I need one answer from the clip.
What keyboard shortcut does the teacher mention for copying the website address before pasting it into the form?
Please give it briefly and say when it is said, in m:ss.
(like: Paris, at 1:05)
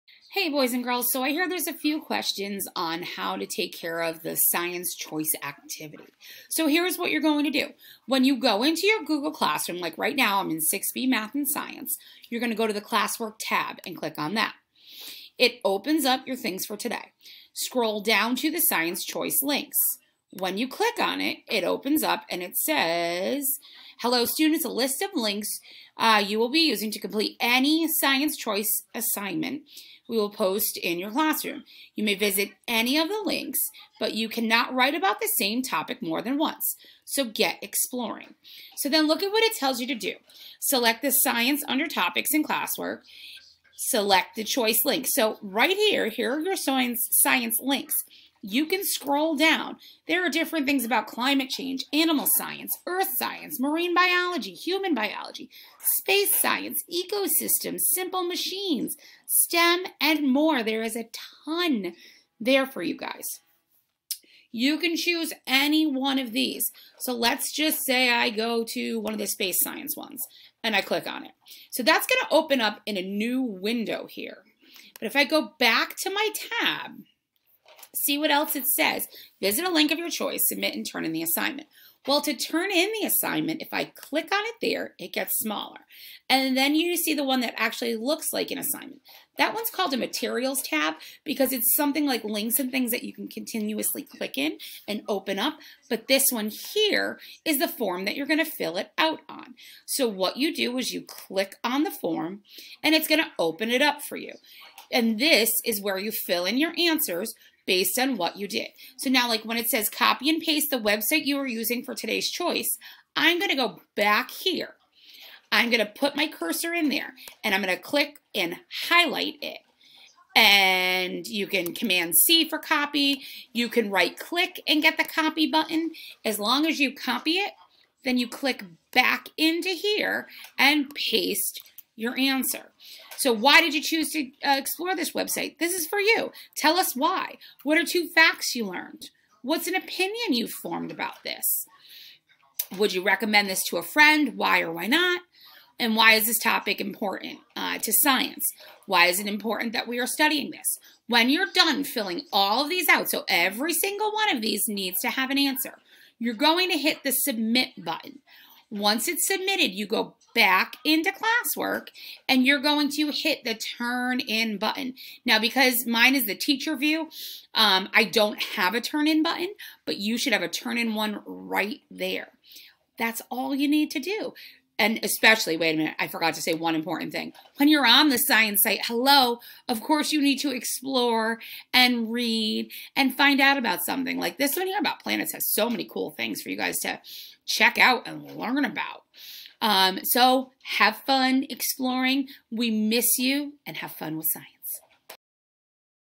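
command C, at 2:01.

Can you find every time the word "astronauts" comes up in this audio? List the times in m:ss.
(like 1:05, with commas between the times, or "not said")
not said.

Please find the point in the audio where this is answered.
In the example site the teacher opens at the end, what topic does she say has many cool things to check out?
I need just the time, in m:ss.
3:04.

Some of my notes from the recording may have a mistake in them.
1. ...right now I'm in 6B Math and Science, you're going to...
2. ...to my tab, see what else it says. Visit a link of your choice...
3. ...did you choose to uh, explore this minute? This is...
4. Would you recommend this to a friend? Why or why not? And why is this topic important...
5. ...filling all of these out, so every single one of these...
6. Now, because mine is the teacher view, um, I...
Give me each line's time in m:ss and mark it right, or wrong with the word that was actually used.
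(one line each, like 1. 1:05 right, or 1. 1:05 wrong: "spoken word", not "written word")
1. 0:09 right
2. 1:16 right
3. 2:13 wrong: "website", not "minute"
4. 2:22 right
5. 2:31 right
6. 2:45 right.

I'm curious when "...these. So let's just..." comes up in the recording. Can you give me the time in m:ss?
1:06.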